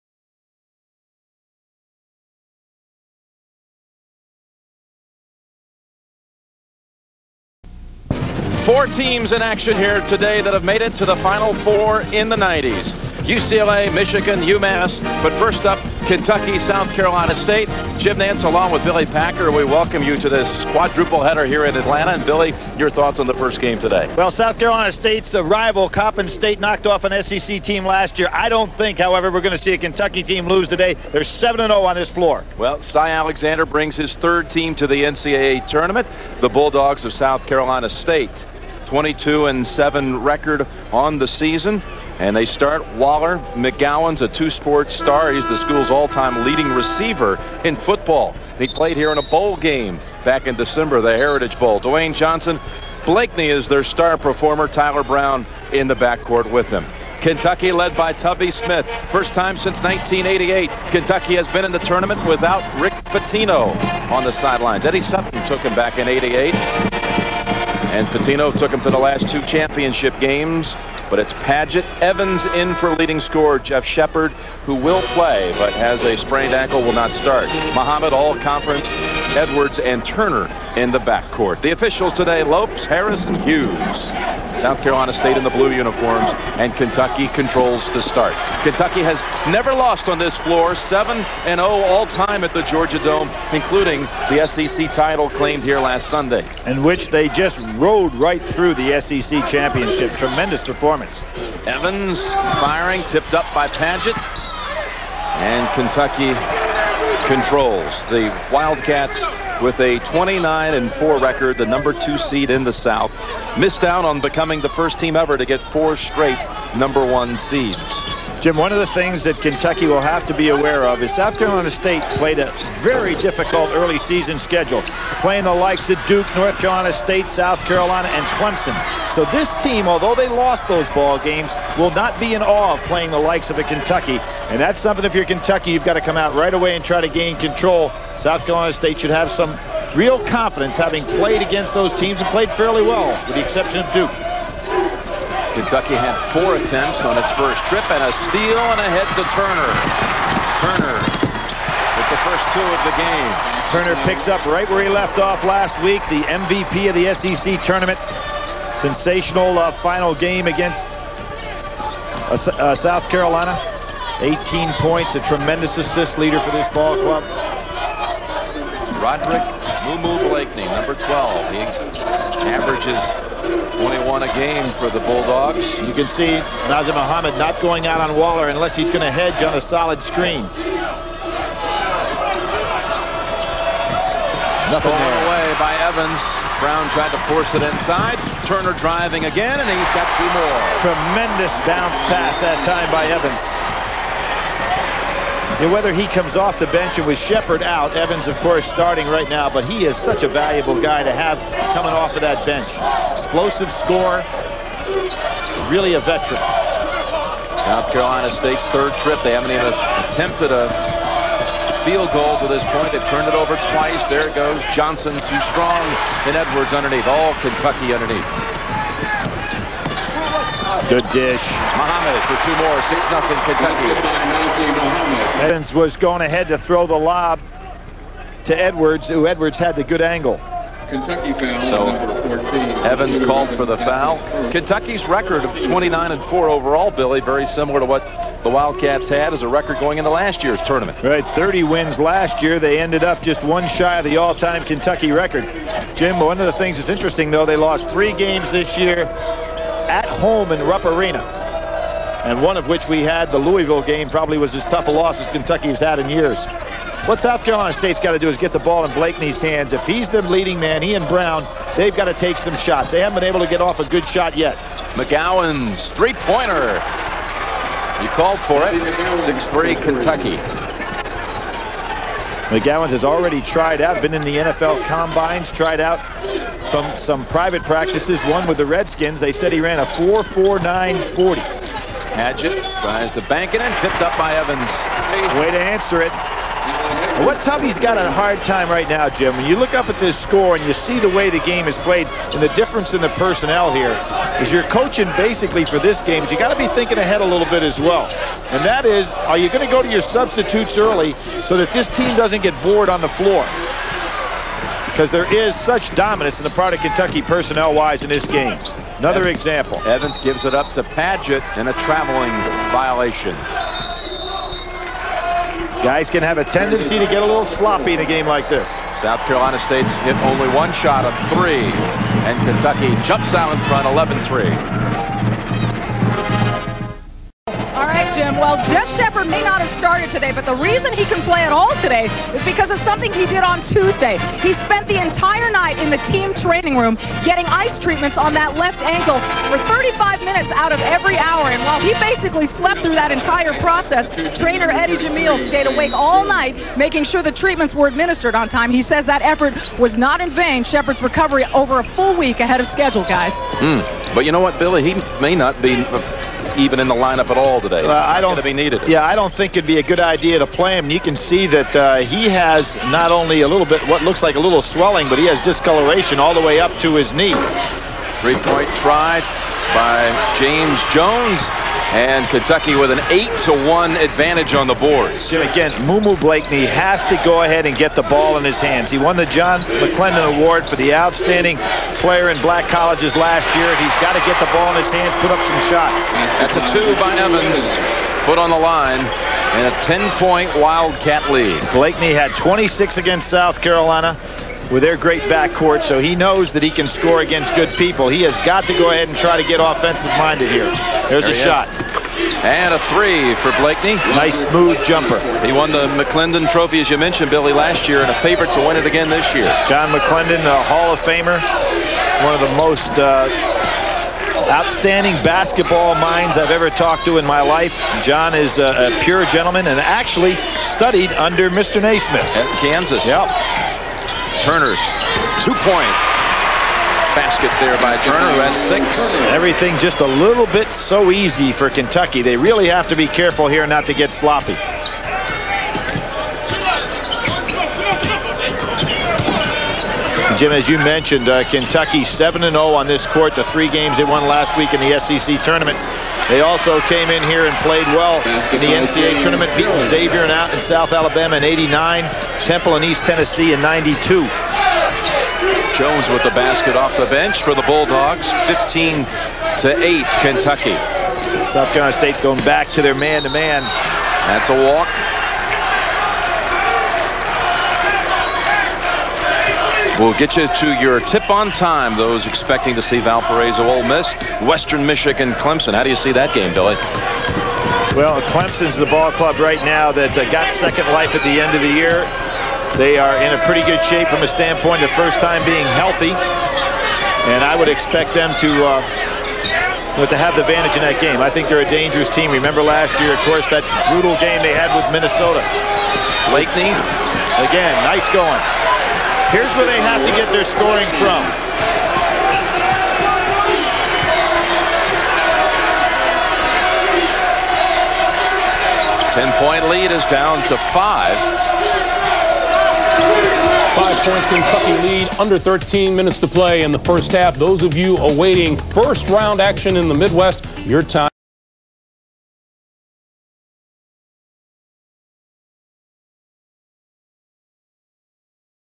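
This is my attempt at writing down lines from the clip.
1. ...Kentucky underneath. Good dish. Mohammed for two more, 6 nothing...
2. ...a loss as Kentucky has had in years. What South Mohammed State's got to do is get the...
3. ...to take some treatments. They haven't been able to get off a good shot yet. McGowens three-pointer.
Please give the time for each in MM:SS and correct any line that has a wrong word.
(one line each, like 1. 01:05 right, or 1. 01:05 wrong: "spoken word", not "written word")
1. 03:37 right
2. 04:14 wrong: "Carolina", not "Mohammed"
3. 04:22 wrong: "shots", not "treatments".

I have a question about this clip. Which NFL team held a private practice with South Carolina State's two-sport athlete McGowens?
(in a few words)
Redskins.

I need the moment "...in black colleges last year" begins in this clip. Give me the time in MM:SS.
06:22.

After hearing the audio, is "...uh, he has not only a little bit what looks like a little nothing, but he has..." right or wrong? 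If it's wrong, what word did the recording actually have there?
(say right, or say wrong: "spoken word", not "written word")
wrong: "swelling", not "nothing".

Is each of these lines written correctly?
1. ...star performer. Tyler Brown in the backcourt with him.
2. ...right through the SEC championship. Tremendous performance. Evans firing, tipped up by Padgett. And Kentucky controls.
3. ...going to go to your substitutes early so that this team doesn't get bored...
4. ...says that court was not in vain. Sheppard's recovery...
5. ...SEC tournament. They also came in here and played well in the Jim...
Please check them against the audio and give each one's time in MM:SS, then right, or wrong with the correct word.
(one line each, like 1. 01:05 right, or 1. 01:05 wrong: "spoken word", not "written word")
1. 00:53 right
2. 01:38 right
3. 04:59 right
4. 05:48 wrong: "effort", not "court"
5. 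07:24 wrong: "NCAA", not "Jim".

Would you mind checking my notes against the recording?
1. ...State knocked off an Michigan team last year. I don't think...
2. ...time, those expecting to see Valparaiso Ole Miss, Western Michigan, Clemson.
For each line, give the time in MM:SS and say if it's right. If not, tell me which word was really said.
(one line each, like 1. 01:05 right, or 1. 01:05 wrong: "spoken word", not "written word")
1. 00:26 wrong: "SEC", not "Michigan"
2. 07:51 right.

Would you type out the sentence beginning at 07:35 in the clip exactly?
Jones with the basket off the bench for the Bulldogs, 15 to 8, Kentucky.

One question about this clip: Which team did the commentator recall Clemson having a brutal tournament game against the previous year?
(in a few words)
Minnesota.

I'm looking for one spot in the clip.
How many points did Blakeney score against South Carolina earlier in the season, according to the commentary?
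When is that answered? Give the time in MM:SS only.
06:32.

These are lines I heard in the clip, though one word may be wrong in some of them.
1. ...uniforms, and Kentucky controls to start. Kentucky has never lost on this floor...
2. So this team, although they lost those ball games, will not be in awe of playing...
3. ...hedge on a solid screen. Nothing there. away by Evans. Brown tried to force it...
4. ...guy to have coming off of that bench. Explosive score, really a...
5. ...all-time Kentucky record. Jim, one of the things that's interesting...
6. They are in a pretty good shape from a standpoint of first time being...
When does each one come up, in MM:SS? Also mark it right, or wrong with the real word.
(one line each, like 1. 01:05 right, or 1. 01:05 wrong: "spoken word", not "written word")
1. 01:25 right
2. 02:09 right
3. 02:59 right
4. 03:20 right
5. 04:04 right
6. 08:02 right.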